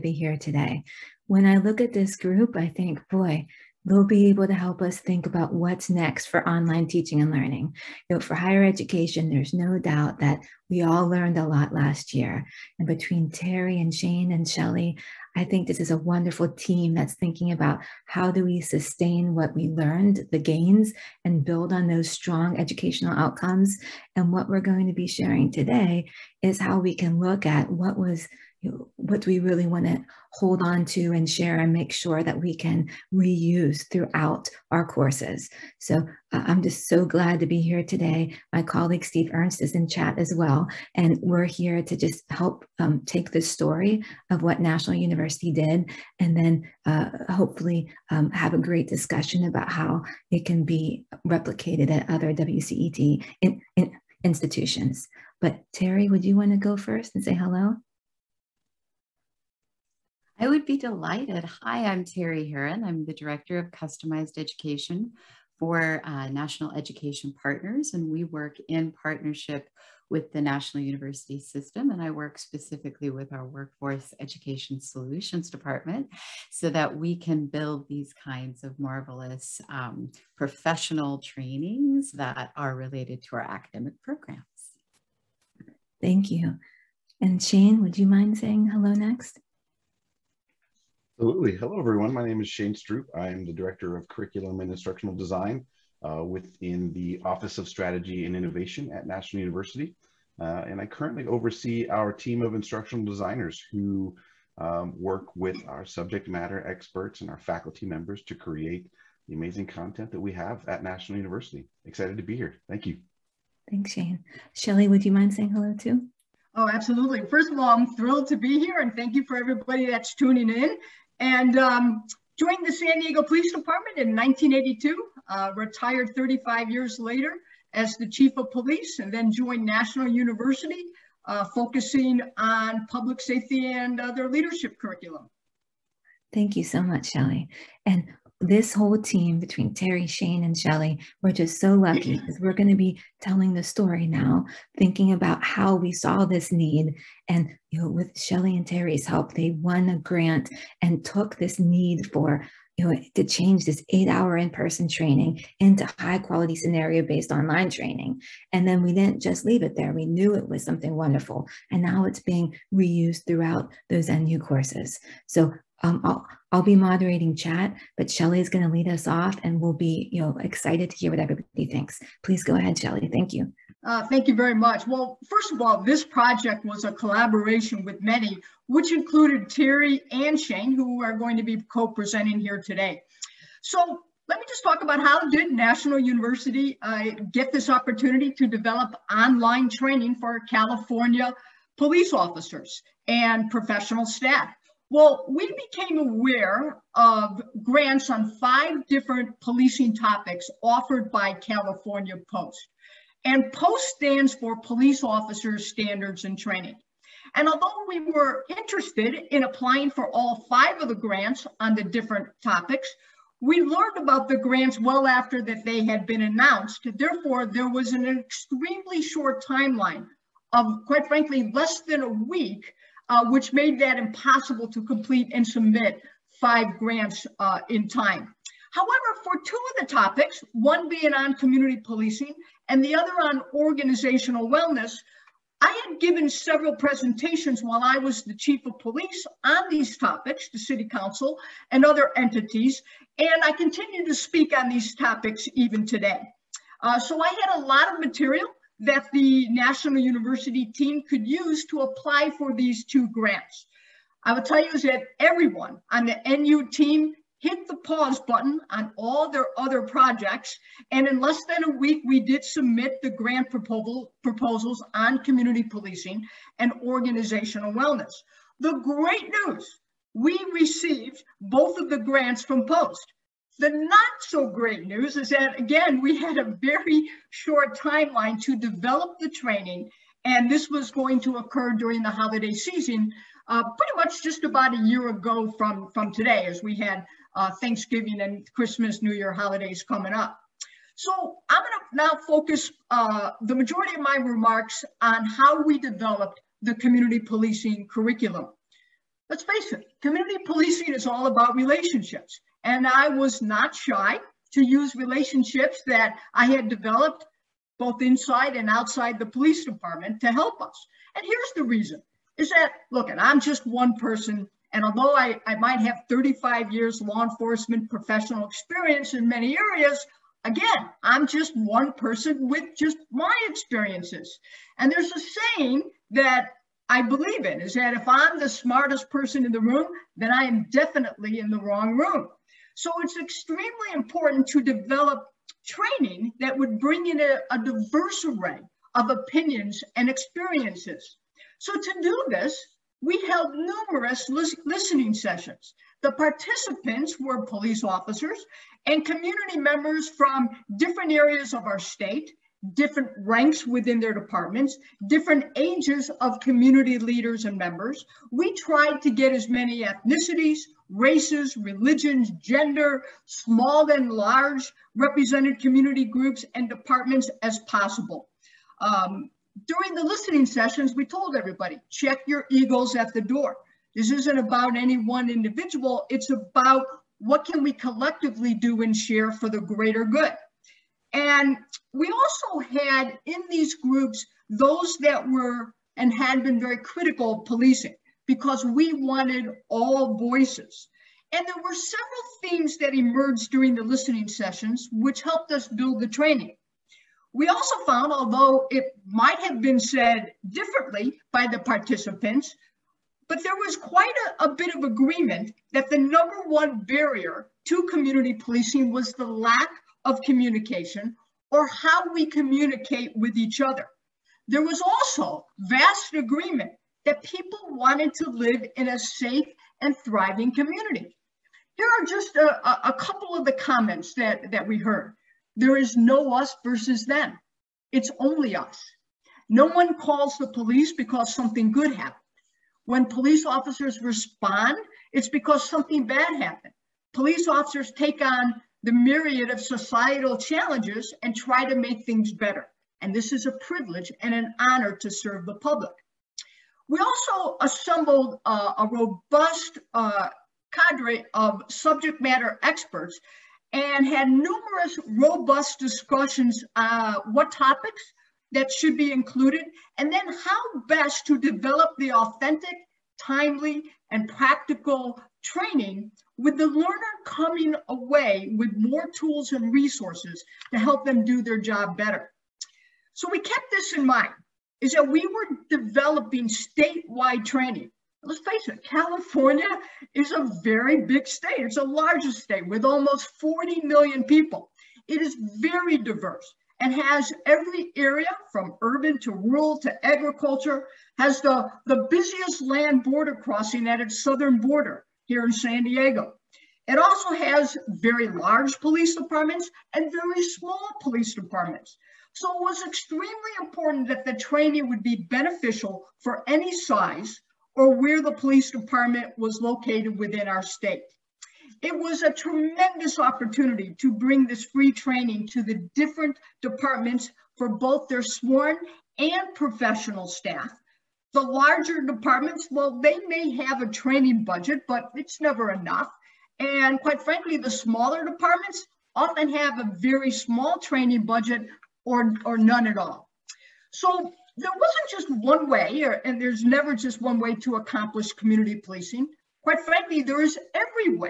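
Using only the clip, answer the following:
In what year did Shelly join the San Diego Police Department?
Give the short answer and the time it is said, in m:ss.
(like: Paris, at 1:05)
1982, at 2:04.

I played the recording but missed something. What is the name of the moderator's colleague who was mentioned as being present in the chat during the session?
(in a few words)
Steve Ernst.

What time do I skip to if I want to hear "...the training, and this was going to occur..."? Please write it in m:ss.
4:39.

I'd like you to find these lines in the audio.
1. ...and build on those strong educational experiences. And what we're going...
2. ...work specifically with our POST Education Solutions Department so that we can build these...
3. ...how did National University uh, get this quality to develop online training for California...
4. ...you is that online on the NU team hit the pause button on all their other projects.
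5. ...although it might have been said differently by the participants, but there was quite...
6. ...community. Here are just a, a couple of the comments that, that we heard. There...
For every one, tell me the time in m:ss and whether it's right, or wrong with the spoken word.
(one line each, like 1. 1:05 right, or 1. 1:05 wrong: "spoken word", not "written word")
1. 0:21 wrong: "outcomes", not "experiences"
2. 1:12 wrong: "Workforce", not "POST"
3. 3:04 wrong: "opportunity", not "quality"
4. 4:14 wrong: "everyone", not "online"
5. 6:38 right
6. 7:00 right.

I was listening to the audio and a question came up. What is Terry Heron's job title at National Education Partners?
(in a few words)
Director of Customized Education.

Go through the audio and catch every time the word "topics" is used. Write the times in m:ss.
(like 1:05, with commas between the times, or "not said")
3:19, 3:32, 3:49, 3:59, 4:04, 7:37.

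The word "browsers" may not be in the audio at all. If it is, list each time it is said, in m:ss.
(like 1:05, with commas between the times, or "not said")
not said.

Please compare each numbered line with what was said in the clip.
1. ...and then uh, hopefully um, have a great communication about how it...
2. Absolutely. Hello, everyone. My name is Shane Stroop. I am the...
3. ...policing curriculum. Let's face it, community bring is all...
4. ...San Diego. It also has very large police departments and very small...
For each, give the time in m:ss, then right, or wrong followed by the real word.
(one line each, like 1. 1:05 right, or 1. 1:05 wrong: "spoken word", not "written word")
1. 0:46 wrong: "discussion", not "communication"
2. 1:31 right
3. 4:57 wrong: "policing", not "bring"
4. 8:15 right.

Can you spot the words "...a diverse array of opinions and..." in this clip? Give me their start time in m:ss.
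5:37.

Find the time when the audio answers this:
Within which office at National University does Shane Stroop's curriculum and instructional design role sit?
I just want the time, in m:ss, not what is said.
1:37.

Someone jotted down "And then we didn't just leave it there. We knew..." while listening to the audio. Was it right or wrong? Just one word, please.
right.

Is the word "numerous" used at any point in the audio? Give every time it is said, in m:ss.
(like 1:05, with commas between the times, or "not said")
5:43, 7:34.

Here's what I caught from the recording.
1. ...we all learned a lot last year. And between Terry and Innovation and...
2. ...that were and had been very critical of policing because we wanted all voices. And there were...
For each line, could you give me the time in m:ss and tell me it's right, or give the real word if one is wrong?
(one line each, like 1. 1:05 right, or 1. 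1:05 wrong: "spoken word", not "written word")
1. 0:10 wrong: "Shane", not "Innovation"
2. 6:25 right.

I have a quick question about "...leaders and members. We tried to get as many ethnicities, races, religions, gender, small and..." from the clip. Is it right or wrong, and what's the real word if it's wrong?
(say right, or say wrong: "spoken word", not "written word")
right.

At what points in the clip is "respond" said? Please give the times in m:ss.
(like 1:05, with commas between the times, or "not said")
7:14.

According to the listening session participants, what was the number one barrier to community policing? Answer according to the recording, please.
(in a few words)
lack of communication.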